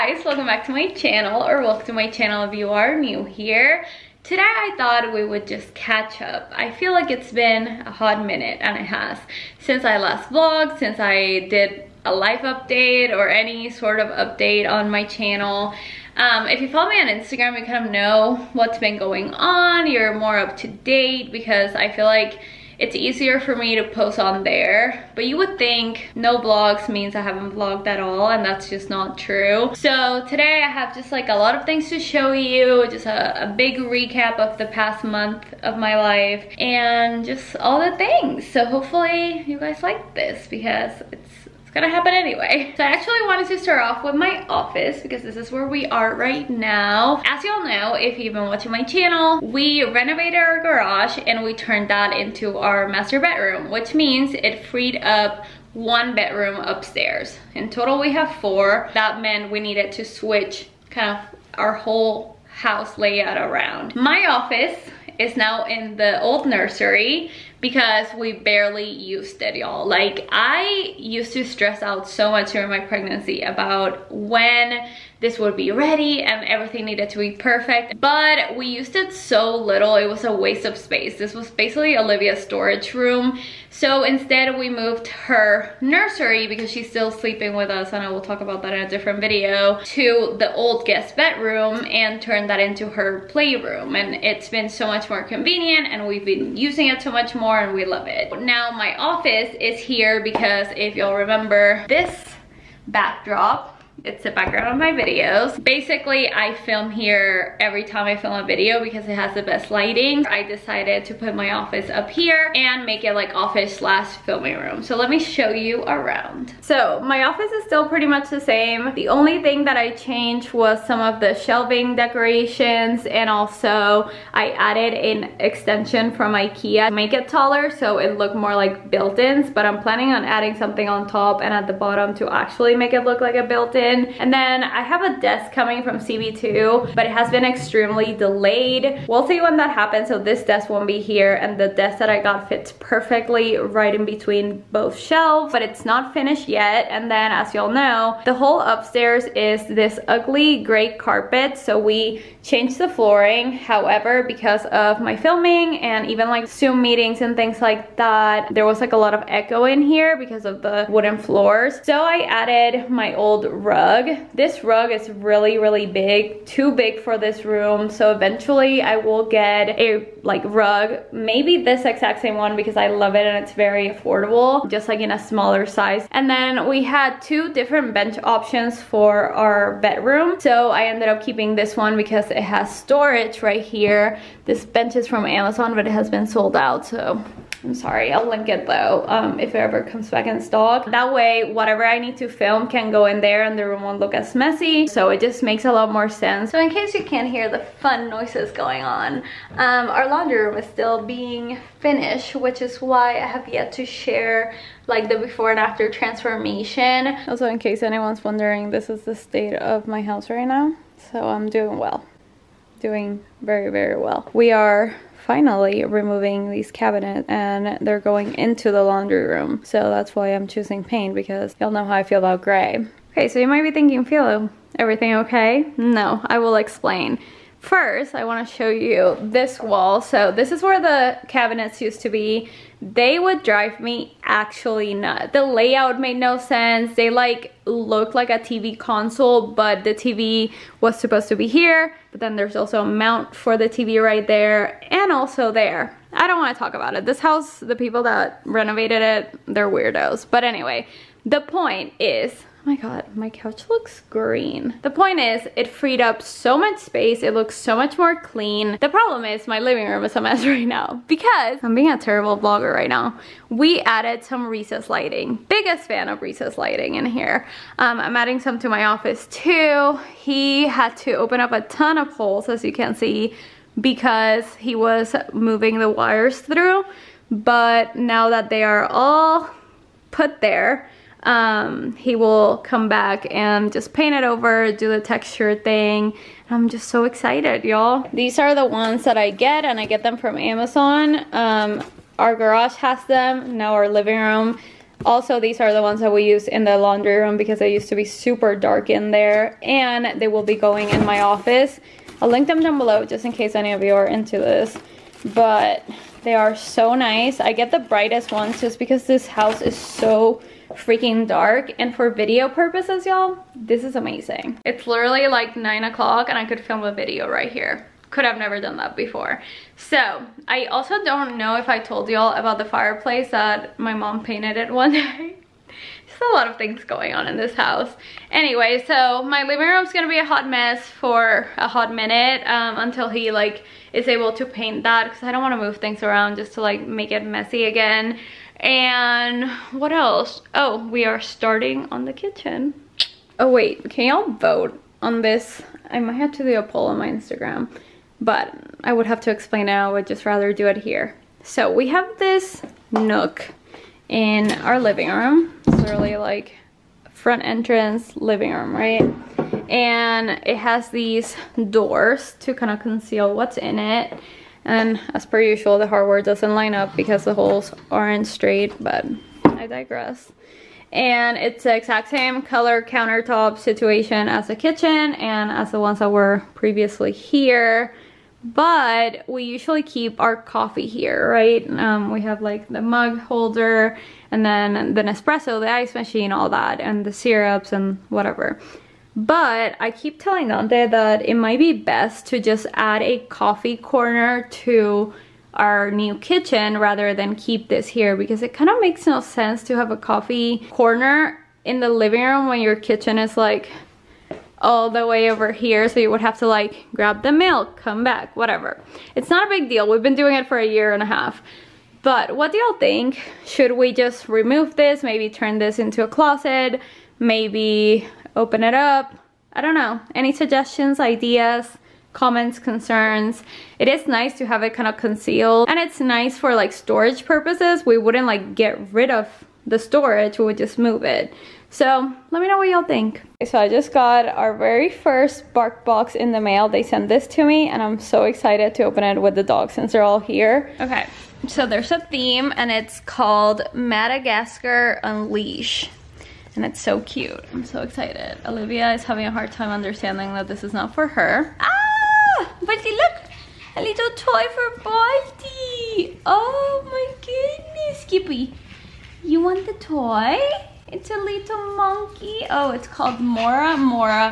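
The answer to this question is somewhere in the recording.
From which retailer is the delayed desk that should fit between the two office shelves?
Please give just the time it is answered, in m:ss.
2:15.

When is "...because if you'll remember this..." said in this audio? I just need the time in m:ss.
1:40.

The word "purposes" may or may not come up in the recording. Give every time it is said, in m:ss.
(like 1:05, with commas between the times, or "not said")
5:12, 7:07.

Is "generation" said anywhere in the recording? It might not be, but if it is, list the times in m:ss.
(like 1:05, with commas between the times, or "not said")
not said.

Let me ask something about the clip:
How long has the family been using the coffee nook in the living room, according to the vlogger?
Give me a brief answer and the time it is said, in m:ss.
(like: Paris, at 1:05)
a year and a half, at 6:50.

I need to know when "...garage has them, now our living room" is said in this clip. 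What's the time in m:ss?
4:52.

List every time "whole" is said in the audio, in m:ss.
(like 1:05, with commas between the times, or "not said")
1:01, 2:28.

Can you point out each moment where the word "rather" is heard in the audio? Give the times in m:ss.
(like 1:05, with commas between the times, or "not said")
5:50, 6:36.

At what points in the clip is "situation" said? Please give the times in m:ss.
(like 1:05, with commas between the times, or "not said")
6:13.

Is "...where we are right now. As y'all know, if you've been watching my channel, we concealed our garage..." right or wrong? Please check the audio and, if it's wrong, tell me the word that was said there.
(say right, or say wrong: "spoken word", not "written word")
wrong: "renovated", not "concealed".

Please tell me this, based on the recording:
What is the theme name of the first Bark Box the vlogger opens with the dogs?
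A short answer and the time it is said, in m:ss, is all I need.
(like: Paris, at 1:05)
Madagascar Unleash, at 7:23.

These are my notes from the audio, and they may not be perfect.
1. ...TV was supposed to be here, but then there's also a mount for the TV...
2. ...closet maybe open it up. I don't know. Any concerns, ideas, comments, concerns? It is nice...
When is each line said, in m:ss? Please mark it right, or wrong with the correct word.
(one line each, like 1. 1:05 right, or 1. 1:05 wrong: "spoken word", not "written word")
1. 3:59 right
2. 6:56 wrong: "suggestions", not "concerns".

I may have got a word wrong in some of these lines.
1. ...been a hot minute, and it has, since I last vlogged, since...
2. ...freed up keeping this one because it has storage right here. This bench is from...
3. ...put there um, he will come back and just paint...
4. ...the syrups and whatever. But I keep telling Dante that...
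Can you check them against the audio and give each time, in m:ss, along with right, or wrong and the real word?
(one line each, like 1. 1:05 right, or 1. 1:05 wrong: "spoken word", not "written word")
1. 0:07 right
2. 3:00 wrong: "ended", not "freed"
3. 4:40 right
4. 6:27 right.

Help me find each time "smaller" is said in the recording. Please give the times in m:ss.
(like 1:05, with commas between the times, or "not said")
2:55.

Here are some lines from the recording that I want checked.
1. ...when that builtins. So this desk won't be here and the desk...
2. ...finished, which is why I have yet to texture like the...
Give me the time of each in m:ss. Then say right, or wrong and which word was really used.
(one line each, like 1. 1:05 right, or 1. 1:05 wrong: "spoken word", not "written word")
1. 2:19 wrong: "happens", not "builtins"
2. 3:21 wrong: "share", not "texture".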